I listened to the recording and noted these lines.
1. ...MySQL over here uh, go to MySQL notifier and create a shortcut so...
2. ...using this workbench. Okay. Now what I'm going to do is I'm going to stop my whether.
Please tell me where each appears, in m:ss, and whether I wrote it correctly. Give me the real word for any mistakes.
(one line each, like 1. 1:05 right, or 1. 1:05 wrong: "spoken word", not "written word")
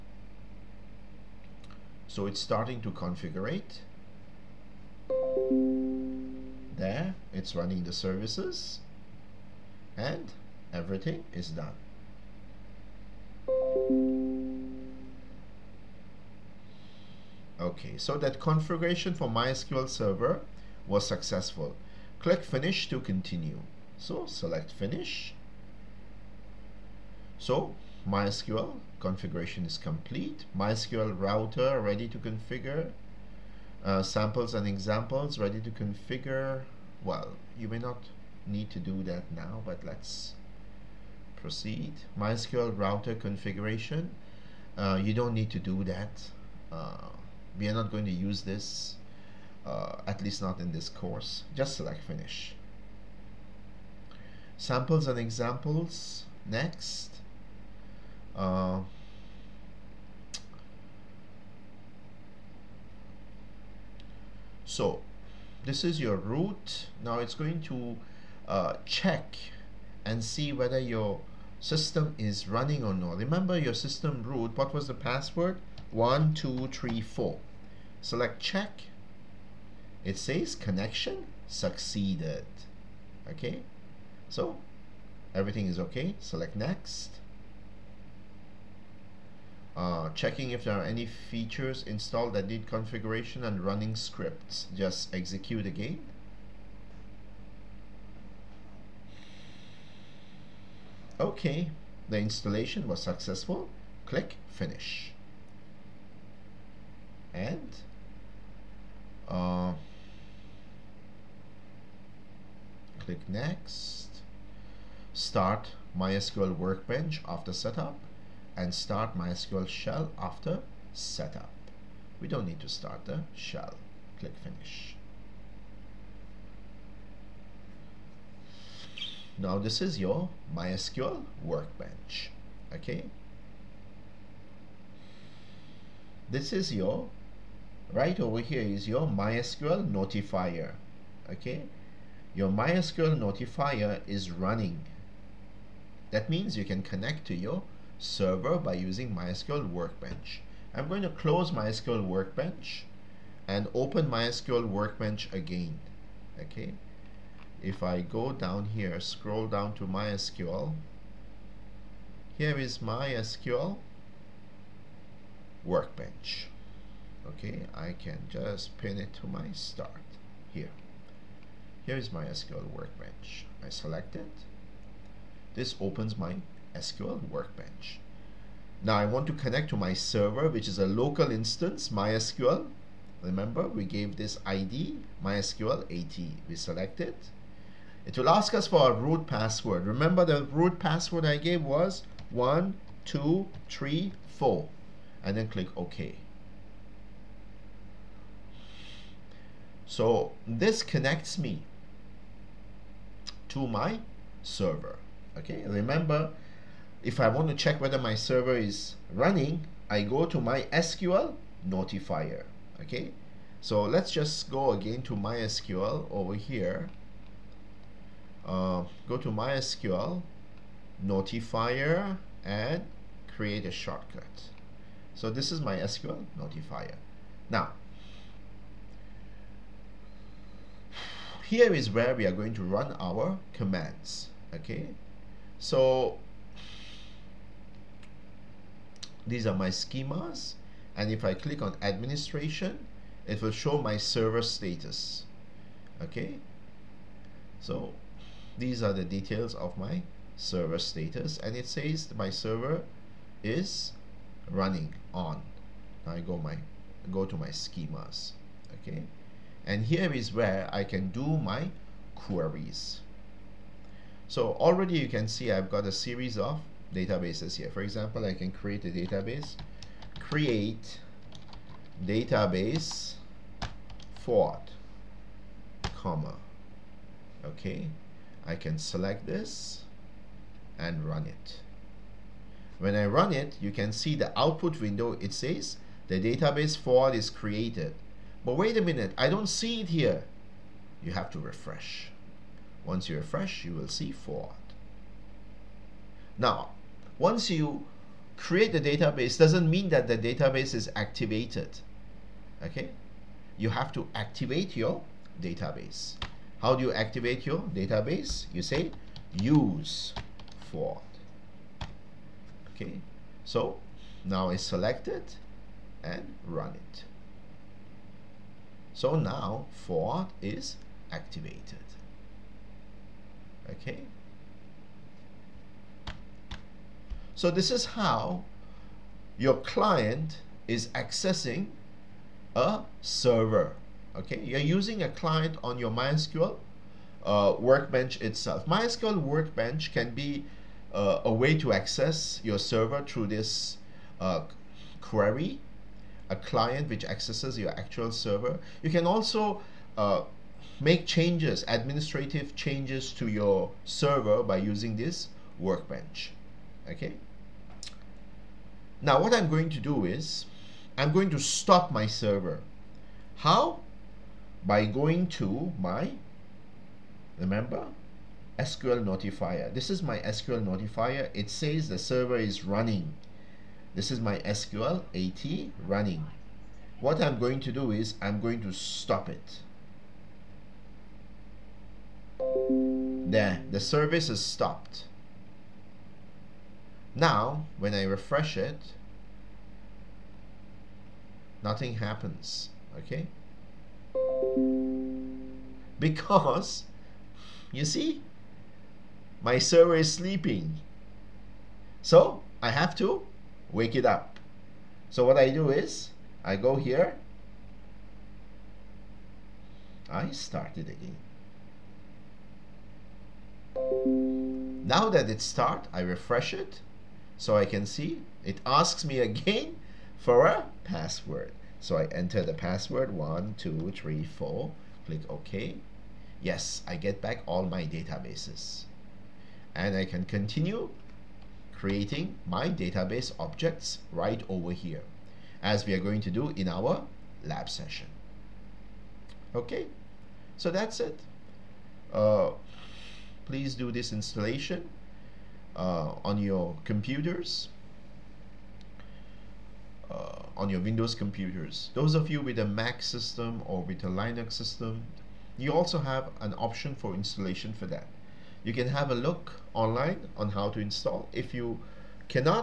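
1. 3:35 right
2. 5:54 wrong: "server", not "whether".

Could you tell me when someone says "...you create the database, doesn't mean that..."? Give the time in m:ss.
4:57.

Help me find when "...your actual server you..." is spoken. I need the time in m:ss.
5:47.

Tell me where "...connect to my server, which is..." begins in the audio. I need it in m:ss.
2:59.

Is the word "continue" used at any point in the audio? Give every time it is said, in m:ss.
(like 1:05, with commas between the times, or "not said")
0:23, 7:10.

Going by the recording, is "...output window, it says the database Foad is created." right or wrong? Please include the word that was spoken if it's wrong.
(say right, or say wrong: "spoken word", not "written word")
right.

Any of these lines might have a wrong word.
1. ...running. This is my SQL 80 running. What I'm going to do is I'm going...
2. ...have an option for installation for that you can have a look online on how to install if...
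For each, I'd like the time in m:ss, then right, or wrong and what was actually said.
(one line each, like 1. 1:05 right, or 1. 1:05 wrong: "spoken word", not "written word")
1. 6:12 right
2. 7:35 right.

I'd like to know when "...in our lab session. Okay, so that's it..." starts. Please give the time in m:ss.
7:16.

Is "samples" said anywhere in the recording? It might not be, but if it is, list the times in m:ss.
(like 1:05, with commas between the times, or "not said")
0:34, 0:54.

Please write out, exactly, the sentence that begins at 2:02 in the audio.
We don't need to start the shell.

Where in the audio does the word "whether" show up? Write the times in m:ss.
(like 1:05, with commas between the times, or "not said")
1:10, 3:27.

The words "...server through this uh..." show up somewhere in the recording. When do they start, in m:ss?
5:42.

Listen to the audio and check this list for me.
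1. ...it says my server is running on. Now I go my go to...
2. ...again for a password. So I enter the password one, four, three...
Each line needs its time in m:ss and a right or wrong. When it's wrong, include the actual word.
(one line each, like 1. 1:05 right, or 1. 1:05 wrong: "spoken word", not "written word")
1. 4:11 right
2. 6:59 wrong: "two", not "four".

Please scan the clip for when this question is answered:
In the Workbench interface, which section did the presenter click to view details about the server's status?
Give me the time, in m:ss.
4:01.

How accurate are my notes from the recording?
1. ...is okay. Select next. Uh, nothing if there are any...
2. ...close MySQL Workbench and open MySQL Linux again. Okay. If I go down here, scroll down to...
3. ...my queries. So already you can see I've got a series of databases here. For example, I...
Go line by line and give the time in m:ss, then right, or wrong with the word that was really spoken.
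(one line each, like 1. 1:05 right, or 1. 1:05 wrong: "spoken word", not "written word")
1. 1:25 wrong: "checking", not "nothing"
2. 2:31 wrong: "Workbench", not "Linux"
3. 4:21 right.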